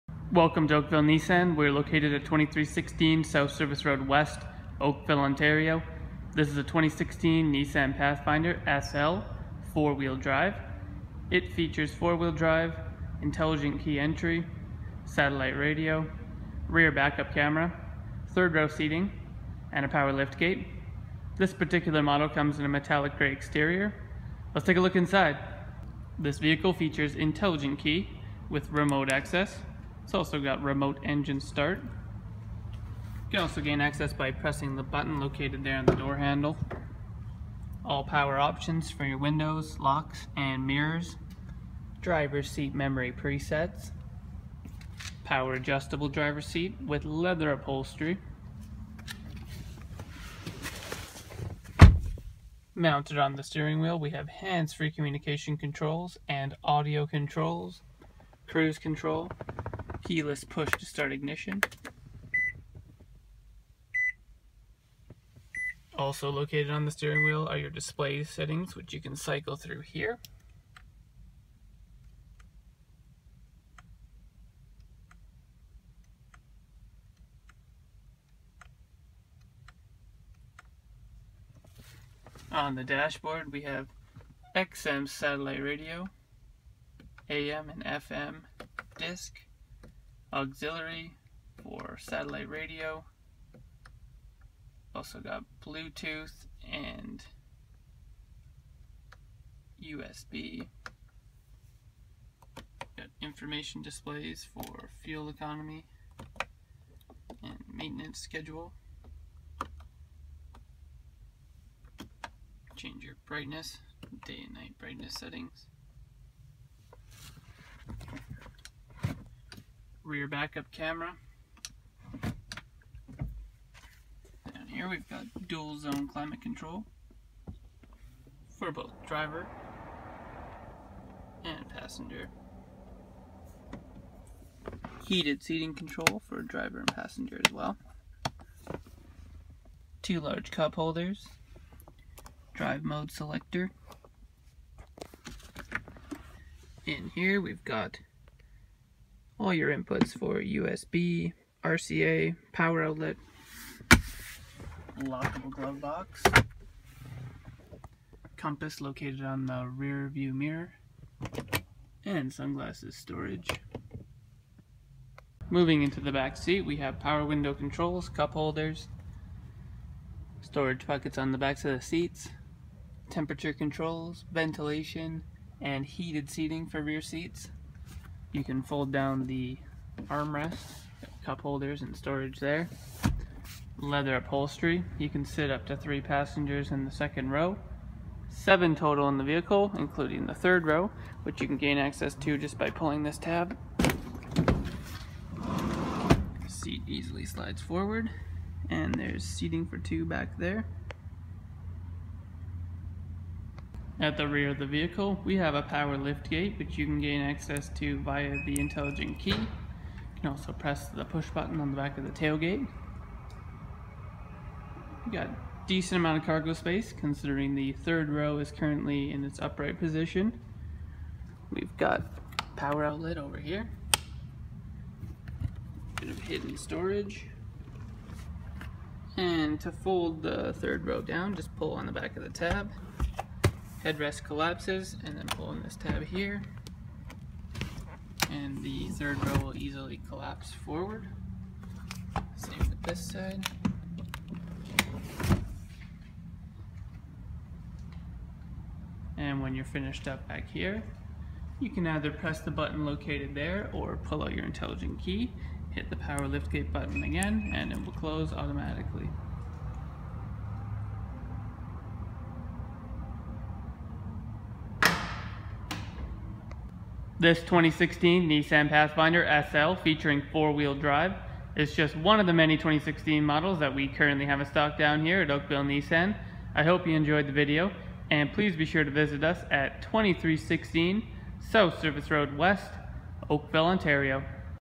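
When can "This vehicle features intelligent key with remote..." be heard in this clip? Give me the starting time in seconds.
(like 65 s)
26 s.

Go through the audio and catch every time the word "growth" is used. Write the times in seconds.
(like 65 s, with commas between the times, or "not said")
not said.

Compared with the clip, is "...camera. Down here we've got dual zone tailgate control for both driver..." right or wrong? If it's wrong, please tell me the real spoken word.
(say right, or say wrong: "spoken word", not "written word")
wrong: "climate", not "tailgate".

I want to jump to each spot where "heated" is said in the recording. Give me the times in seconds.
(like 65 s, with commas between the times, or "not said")
135 s, 175 s.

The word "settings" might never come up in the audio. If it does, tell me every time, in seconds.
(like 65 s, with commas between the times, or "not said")
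68 s, 115 s.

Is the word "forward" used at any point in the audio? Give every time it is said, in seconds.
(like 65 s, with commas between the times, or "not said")
197 s, 240 s.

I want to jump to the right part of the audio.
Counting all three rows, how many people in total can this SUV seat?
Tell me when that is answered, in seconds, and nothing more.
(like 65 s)
188 s.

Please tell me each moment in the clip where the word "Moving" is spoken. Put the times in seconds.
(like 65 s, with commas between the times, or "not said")
165 s.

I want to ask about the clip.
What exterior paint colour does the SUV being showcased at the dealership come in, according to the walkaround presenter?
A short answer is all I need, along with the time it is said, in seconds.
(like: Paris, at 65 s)
Metallic gray, at 22 s.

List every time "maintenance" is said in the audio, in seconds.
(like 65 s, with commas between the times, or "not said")
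107 s.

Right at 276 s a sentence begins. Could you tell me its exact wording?
I hope you enjoyed the video and please be sure to visit us at 2316 South Service Road West, Oakville, Ontario.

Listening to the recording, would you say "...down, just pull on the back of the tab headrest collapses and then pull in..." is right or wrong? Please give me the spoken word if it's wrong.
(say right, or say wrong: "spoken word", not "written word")
right.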